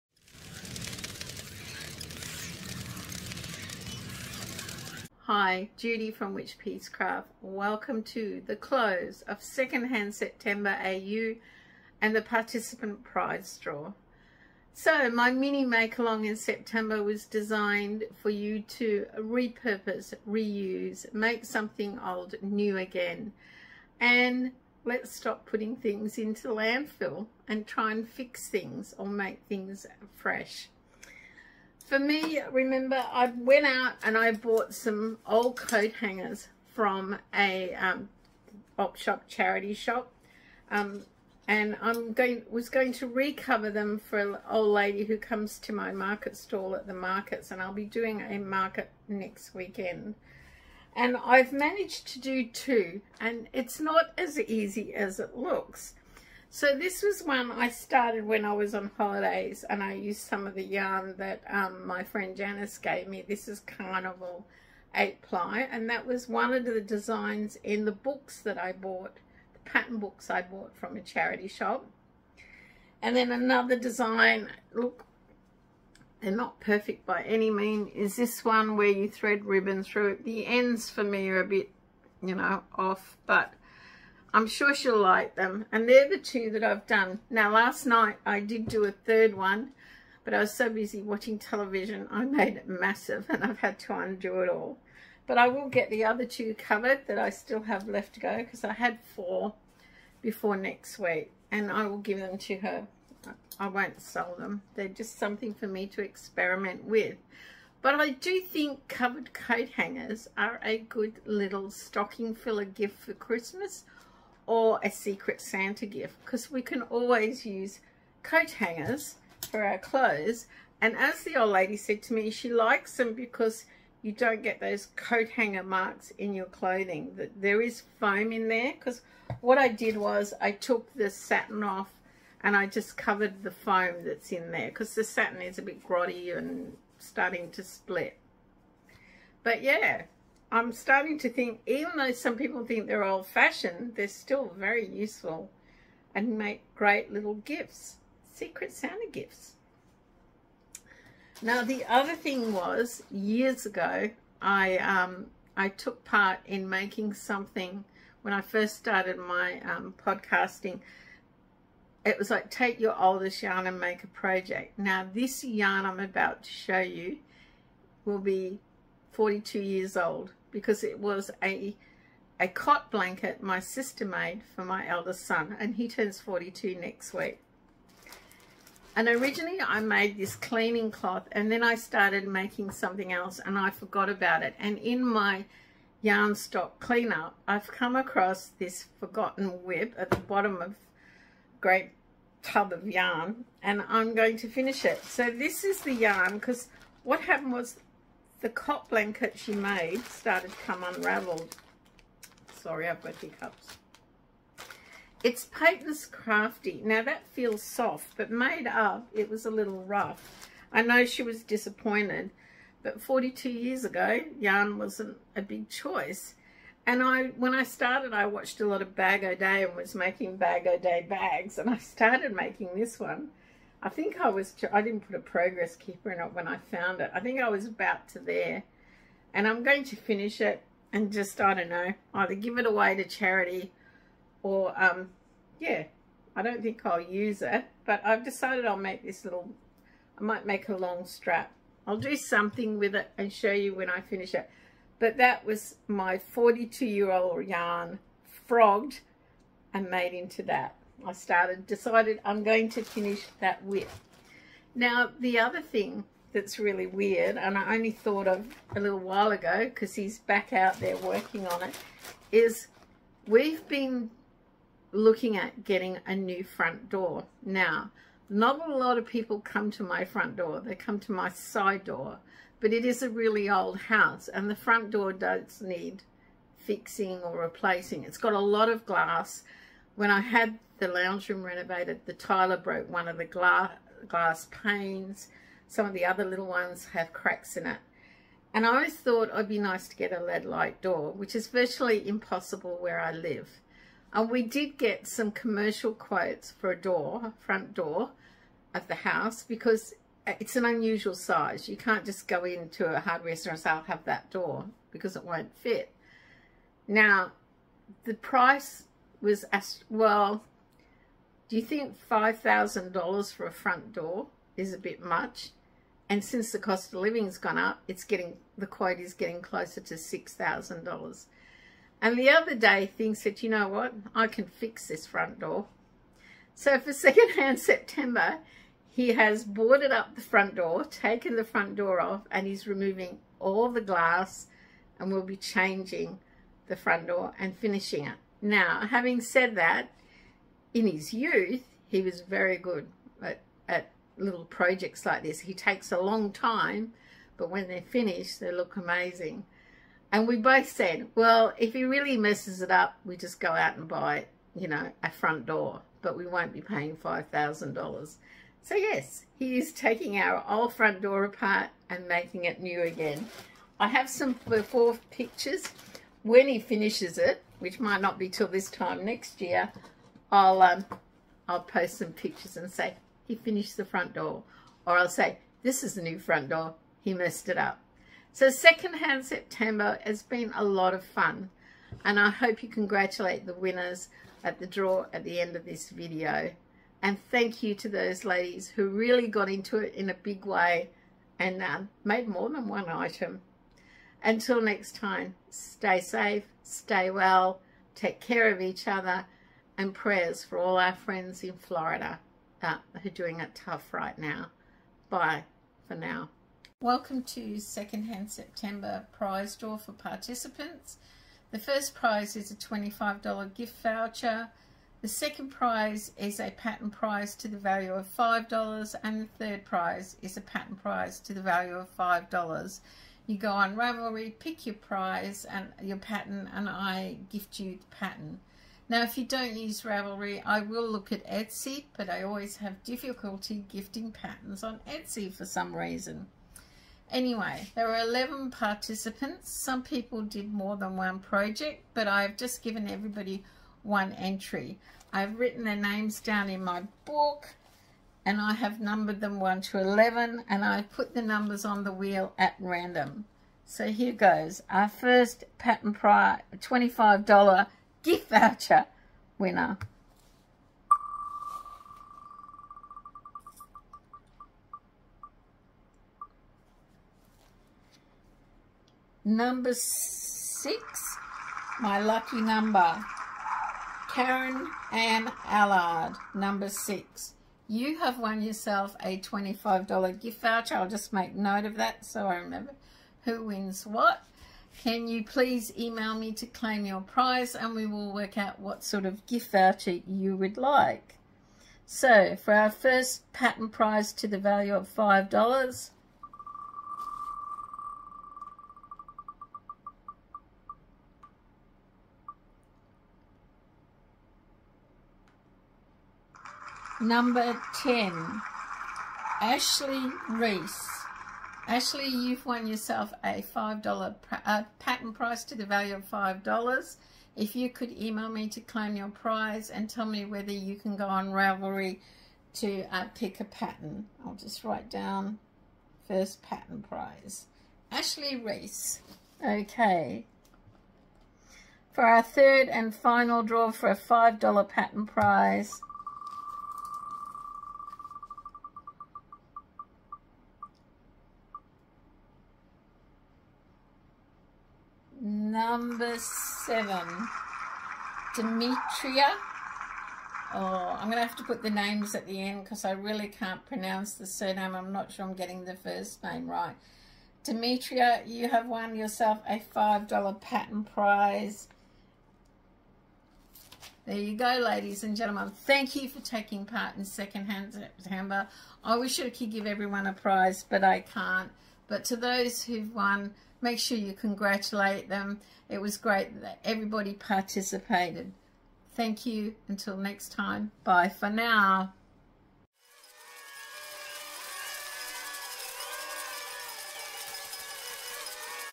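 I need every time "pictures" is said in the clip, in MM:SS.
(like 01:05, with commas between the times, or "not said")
06:05, 06:12.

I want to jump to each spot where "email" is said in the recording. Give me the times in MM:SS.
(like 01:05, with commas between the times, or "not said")
08:05, 08:37.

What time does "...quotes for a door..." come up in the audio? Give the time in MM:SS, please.
04:55.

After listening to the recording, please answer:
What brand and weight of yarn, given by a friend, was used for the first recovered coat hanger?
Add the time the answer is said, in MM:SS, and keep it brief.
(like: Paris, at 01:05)
Carnival 8 ply, at 01:03.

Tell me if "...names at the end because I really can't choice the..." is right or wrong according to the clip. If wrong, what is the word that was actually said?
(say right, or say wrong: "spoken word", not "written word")
wrong: "pronounce", not "choice".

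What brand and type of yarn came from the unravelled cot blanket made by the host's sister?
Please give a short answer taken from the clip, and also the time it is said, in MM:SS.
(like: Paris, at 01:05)
Patons Crafty, at 03:25.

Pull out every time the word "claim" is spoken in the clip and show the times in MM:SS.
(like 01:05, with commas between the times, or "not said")
08:06, 08:38.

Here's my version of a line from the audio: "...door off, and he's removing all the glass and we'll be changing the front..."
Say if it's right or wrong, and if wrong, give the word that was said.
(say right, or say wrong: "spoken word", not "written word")
right.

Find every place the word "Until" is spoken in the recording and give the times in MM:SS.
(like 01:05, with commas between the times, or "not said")
06:34, 09:39.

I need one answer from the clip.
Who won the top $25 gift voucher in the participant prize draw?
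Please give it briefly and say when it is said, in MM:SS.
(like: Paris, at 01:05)
Karen Ann Allard, at 07:54.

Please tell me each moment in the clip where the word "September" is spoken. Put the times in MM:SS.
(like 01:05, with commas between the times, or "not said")
00:10, 00:16, 05:27, 06:19, 06:48, 09:27.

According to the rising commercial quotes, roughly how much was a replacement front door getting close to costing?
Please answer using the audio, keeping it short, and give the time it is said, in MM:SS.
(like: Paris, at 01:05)
$6,000, at 05:19.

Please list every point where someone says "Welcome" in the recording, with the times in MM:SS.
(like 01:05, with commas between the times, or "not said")
00:07, 06:46.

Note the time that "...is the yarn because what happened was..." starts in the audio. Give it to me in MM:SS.
03:15.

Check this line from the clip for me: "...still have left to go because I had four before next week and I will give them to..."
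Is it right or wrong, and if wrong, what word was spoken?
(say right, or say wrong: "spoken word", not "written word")
right.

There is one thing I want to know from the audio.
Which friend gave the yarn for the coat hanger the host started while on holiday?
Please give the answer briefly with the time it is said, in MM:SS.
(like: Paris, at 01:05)
Janice, at 01:02.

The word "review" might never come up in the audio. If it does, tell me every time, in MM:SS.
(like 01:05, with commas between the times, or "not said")
not said.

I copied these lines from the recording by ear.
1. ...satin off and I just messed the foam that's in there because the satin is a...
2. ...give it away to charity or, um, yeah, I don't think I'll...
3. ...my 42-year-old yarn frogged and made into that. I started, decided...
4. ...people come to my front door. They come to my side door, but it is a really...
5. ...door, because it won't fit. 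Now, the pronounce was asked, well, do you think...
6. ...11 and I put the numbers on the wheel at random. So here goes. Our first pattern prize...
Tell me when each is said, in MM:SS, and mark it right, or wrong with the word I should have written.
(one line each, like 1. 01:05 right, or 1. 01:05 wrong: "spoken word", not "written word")
1. 02:11 wrong: "covered", not "messed"
2. 03:52 right
3. 04:05 right
4. 04:29 right
5. 05:04 wrong: "price", not "pronounce"
6. 07:29 right.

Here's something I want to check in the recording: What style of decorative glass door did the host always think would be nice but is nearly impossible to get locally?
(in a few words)
lead light door.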